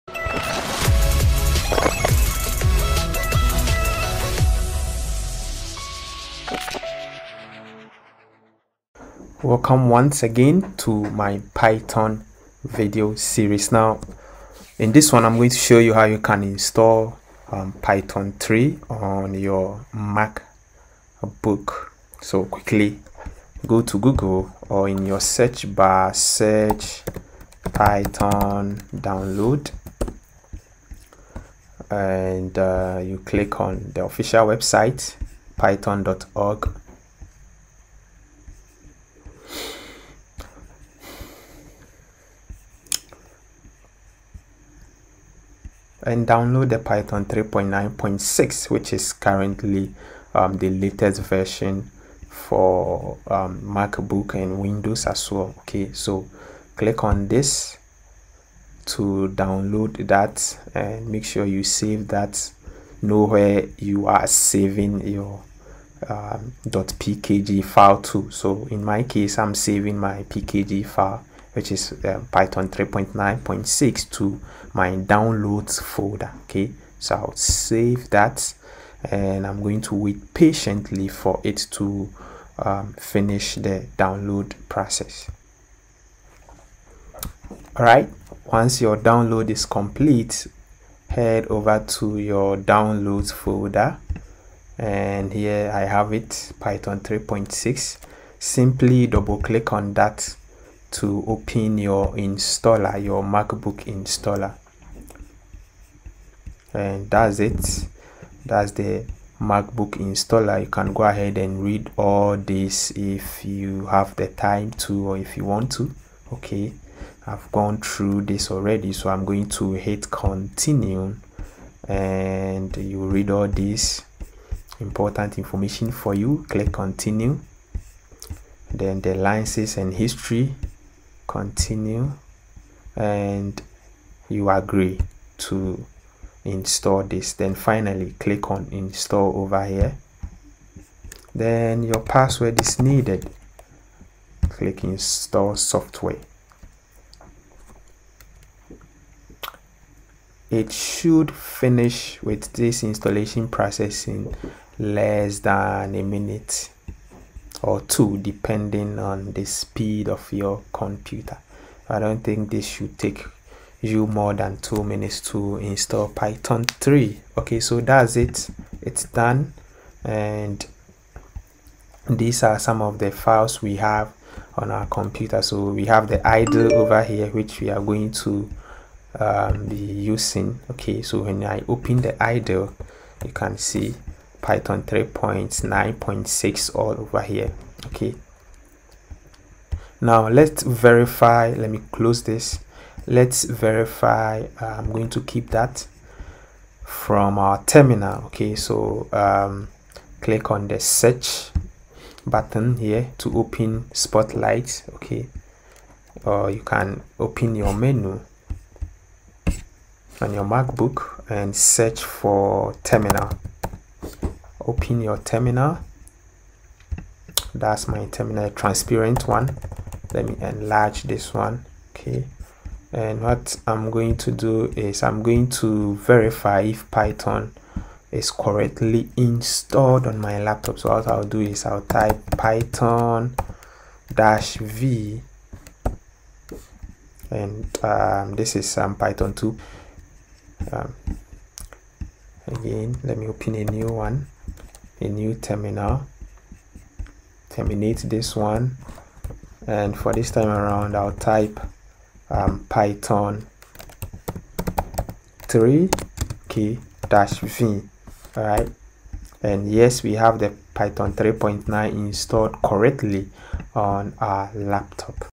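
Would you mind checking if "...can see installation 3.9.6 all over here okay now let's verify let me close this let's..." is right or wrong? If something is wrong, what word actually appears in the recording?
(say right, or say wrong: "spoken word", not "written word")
wrong: "python", not "installation".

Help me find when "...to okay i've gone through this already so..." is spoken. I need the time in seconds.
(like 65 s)
115 s.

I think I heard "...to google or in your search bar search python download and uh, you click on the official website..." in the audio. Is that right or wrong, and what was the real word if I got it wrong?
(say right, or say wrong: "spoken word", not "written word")
right.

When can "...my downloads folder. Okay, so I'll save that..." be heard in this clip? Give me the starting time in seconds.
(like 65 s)
74 s.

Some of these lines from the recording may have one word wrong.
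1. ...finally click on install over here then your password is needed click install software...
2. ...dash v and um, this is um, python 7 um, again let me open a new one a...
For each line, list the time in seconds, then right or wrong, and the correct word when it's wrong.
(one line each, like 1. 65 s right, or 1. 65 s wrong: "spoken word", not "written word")
1. 137 s right
2. 234 s wrong: "2", not "7".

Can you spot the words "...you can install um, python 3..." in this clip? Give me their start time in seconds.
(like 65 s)
16 s.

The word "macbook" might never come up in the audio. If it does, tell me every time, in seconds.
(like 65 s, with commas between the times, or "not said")
53 s, 103 s, 109 s, 210 s.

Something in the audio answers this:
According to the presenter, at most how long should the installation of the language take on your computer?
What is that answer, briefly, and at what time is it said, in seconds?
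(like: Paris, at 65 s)
2 minutes, at 164 s.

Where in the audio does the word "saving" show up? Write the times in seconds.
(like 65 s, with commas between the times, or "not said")
64 s, 69 s.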